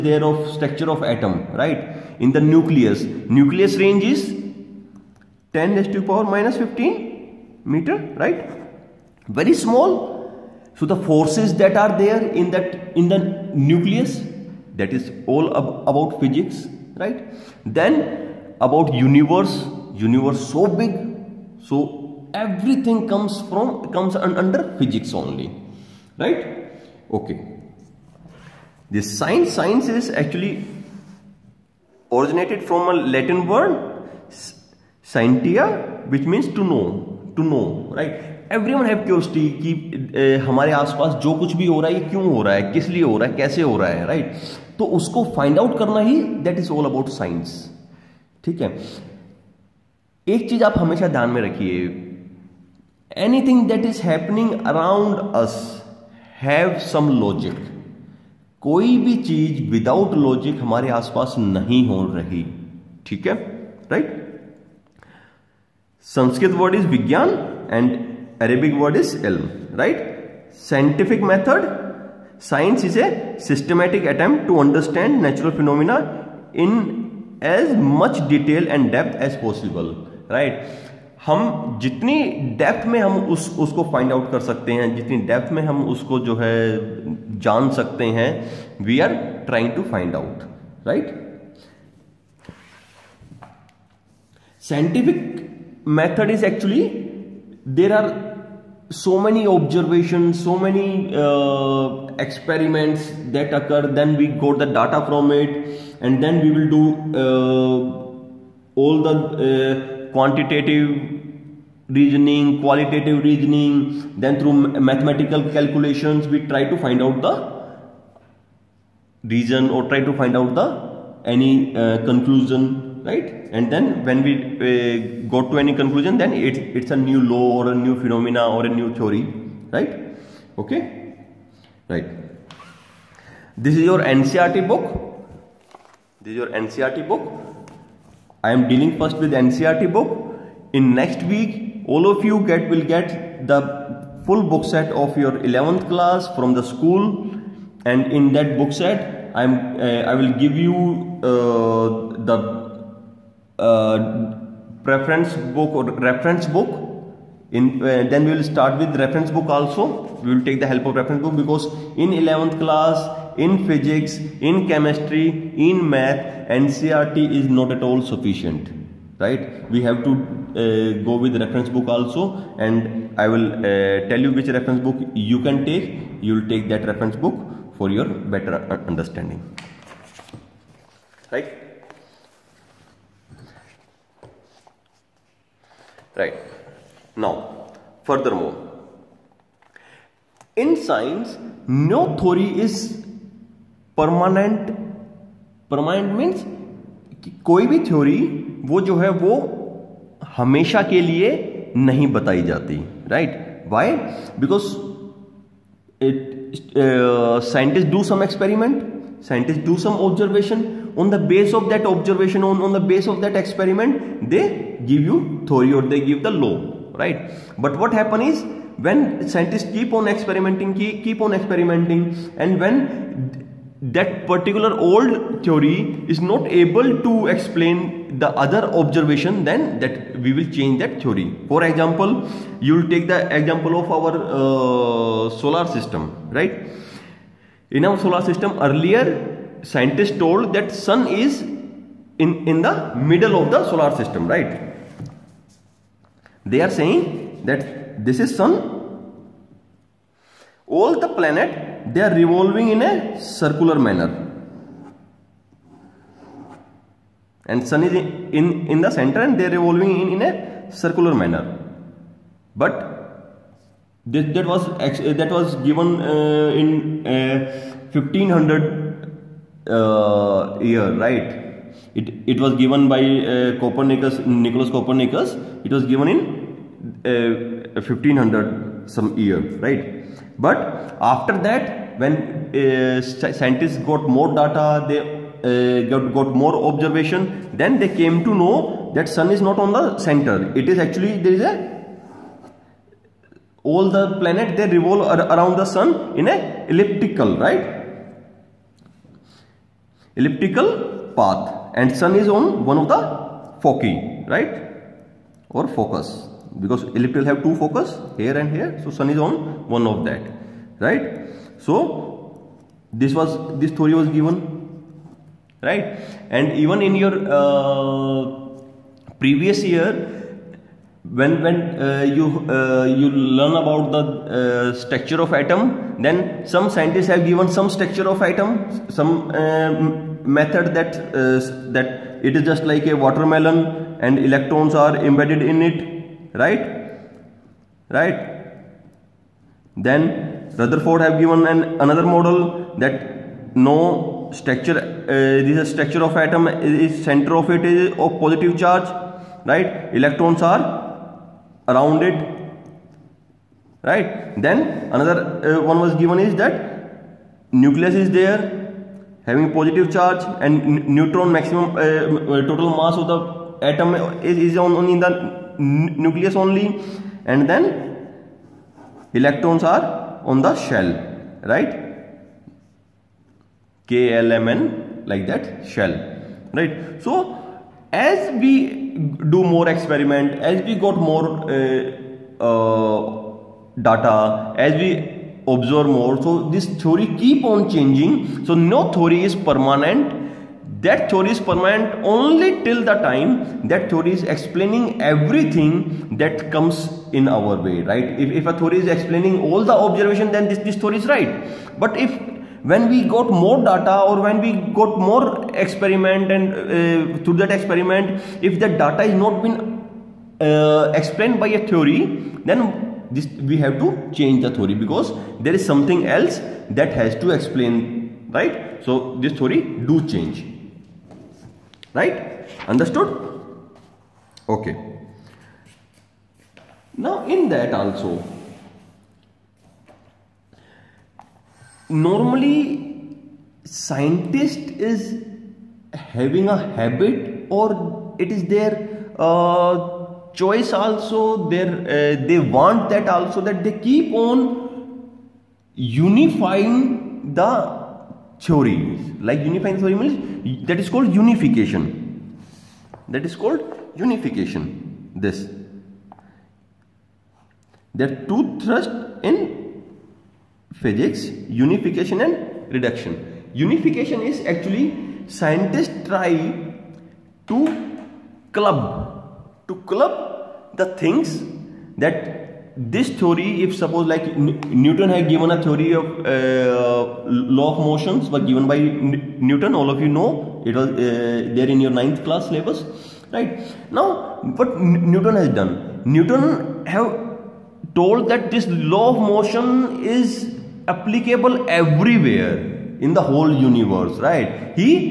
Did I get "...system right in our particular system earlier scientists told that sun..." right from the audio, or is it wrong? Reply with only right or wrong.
wrong.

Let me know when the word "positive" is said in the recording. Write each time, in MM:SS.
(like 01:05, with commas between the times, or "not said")
05:48, 05:59.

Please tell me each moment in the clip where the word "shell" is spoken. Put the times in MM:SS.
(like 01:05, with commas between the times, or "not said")
06:10, 06:15.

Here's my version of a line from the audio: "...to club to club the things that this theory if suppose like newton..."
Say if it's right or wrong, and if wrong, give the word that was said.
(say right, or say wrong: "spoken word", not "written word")
right.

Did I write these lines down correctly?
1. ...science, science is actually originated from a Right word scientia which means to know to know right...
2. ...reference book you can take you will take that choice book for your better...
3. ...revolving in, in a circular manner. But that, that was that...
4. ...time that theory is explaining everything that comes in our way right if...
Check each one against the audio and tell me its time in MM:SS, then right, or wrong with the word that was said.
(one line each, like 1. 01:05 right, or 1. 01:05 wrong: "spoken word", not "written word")
1. 00:29 wrong: "Latin", not "Right"
2. 02:54 wrong: "reference", not "choice"
3. 04:19 right
4. 06:33 right.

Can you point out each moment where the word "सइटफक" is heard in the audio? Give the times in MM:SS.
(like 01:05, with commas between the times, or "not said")
01:10, 01:34.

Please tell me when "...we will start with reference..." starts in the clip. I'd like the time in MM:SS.
02:38.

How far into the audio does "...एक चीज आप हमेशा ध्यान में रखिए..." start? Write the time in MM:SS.
00:50.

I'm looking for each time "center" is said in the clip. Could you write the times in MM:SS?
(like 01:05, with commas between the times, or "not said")
04:18, 04:49, 05:47.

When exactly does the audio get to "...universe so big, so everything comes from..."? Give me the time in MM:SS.
00:19.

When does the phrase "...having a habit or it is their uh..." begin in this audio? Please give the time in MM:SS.
07:15.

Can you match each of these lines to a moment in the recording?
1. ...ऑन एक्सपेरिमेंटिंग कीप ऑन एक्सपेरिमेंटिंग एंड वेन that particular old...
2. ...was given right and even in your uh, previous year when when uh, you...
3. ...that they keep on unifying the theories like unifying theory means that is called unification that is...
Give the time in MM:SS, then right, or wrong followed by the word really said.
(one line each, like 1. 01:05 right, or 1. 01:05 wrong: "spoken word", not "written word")
1. 03:39 right
2. 05:13 right
3. 07:23 right.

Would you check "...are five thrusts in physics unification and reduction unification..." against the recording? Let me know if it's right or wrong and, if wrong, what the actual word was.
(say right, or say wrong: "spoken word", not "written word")
wrong: "two", not "five".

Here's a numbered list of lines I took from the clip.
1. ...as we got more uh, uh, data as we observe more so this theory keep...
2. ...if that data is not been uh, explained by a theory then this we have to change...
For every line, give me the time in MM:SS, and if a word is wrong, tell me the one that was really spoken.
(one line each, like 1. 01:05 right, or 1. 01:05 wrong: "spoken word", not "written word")
1. 06:20 right
2. 06:48 right.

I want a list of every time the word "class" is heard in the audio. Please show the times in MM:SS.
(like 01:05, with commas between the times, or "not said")
02:25, 02:42, 08:02.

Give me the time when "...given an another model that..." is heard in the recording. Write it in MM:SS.
05:41.